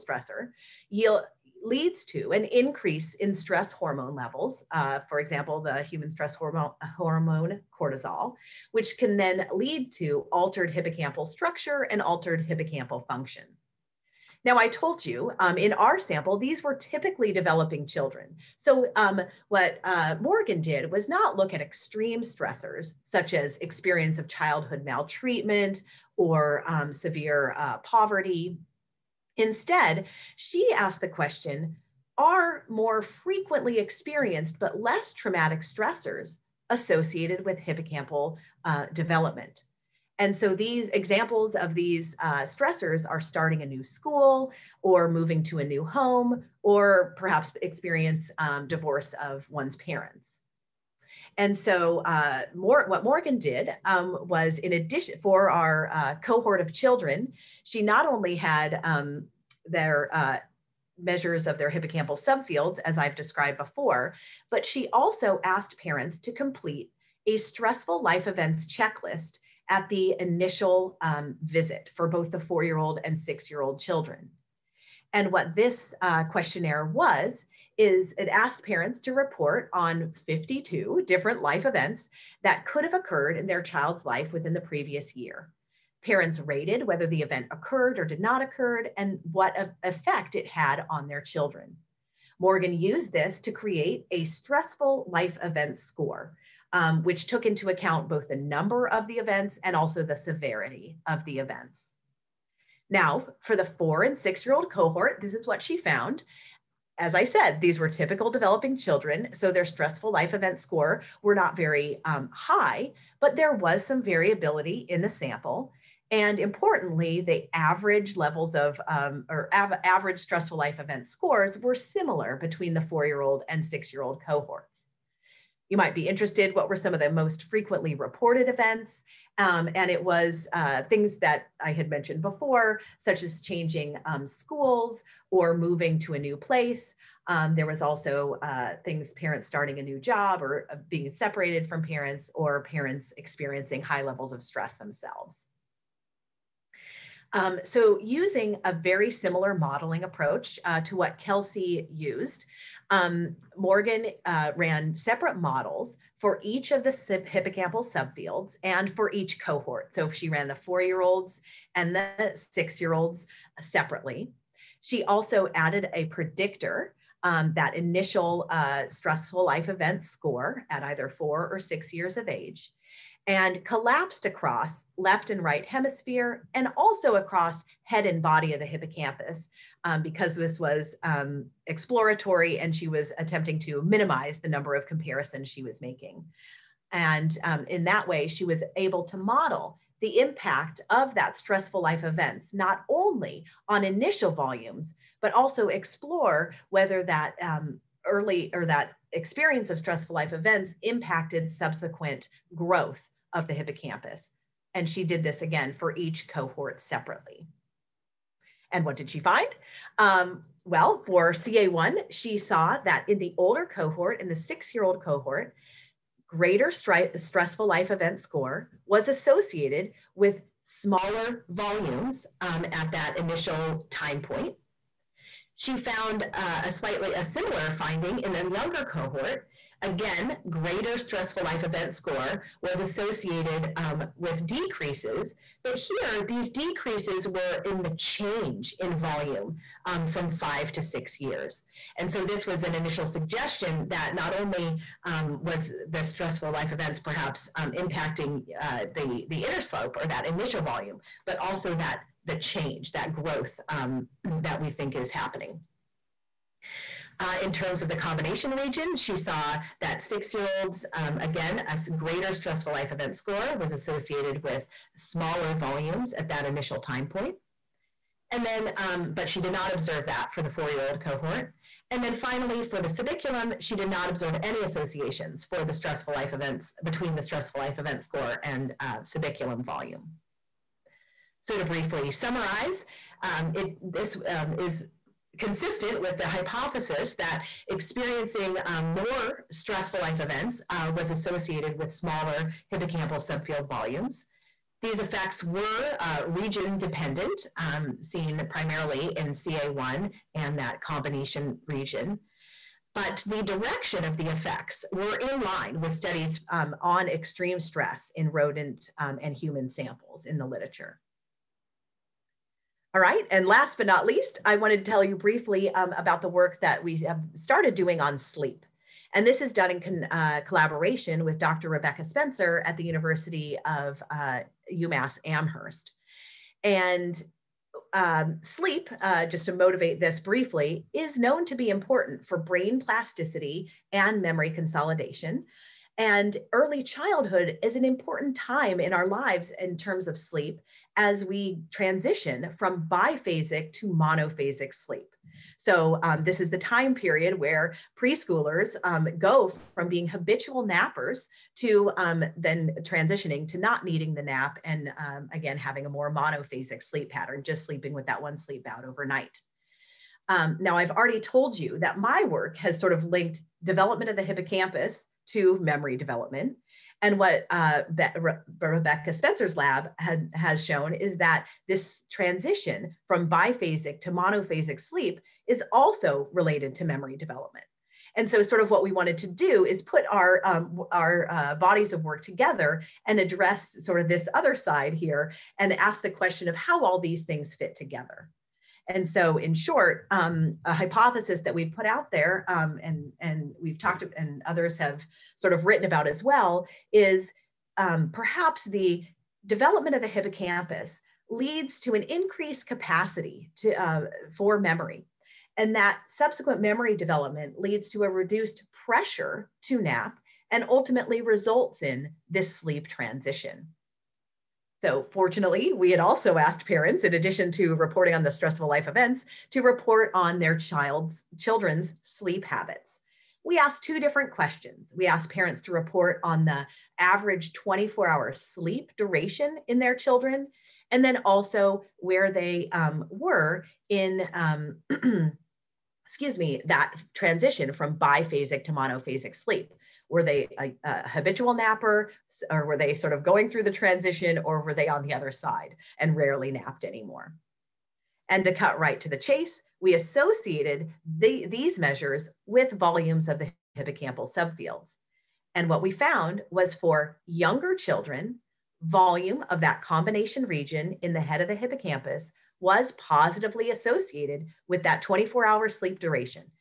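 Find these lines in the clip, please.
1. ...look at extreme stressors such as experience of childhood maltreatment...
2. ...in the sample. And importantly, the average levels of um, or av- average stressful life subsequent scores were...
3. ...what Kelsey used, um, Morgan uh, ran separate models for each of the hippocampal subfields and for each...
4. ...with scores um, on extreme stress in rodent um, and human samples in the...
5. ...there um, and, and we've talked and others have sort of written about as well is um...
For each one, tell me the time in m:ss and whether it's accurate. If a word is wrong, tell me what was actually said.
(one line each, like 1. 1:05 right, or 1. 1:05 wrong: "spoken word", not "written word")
1. 0:21 right
2. 1:54 wrong: "event", not "subsequent"
3. 2:30 right
4. 5:05 wrong: "studies", not "scores"
5. 6:32 right.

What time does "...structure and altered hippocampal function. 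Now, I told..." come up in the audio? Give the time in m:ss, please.
0:11.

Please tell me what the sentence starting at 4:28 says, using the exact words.
And then, um, but she did not observe that for the four-year-old cohort.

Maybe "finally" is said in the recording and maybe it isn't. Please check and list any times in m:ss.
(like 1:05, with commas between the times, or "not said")
4:32.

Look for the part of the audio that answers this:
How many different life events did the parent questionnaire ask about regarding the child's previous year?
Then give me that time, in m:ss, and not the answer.
1:20.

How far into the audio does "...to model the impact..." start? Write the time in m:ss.
3:09.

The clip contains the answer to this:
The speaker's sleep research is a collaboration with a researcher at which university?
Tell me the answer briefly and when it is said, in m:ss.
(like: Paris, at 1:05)
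UMass Amherst, at 5:24.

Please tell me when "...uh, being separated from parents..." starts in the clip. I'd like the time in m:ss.
2:20.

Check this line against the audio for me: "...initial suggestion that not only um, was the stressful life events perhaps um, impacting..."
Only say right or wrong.
right.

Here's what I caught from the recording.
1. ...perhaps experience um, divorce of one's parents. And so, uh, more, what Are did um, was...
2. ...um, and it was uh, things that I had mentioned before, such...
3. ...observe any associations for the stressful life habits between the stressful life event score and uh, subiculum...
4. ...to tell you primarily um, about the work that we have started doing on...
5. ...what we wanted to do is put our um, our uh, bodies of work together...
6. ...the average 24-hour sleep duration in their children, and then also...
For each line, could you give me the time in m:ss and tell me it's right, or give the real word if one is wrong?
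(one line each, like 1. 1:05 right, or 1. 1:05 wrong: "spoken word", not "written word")
1. 0:47 wrong: "Morgan", not "Are"
2. 2:09 right
3. 4:34 wrong: "events", not "habits"
4. 5:14 wrong: "briefly", not "primarily"
5. 6:18 right
6. 7:06 right.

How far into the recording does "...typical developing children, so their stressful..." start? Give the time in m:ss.
1:47.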